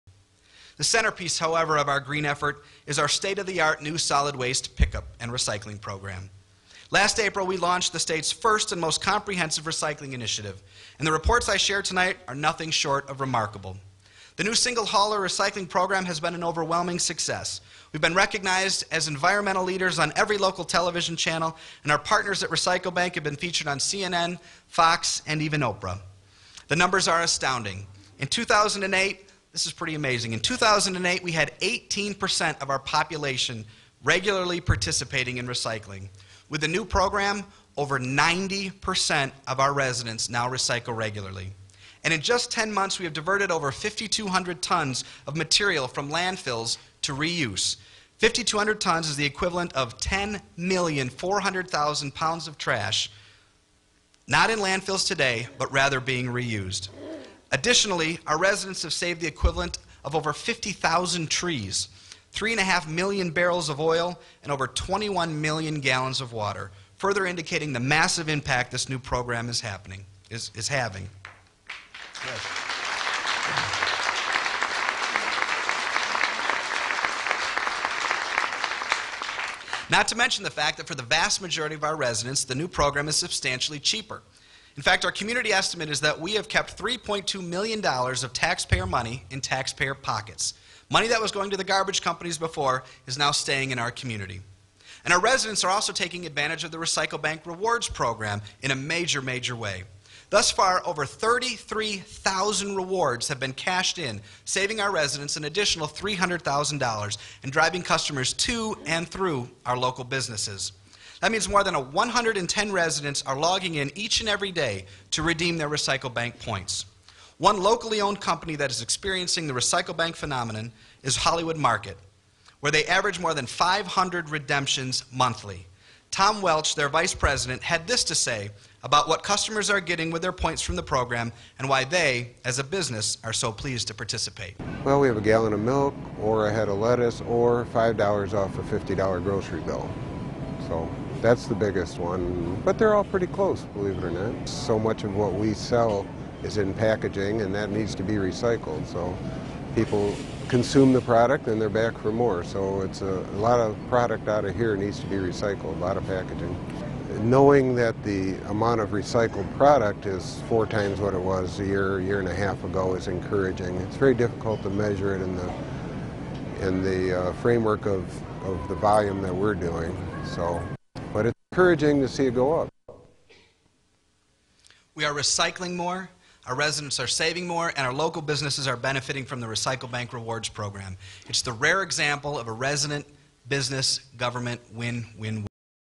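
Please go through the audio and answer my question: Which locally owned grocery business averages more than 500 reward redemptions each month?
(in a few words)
Hollywood Market.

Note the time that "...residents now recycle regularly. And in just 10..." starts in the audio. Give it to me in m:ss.
0:39.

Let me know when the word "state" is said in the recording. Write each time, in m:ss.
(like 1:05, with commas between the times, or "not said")
0:03, 0:07.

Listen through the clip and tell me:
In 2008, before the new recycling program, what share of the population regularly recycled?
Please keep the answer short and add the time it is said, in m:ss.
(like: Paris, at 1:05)
18%, at 0:31.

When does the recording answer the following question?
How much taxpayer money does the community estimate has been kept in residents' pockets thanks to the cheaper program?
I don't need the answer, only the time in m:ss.
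1:26.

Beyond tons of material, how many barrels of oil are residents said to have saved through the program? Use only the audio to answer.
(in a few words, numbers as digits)
3.5 million.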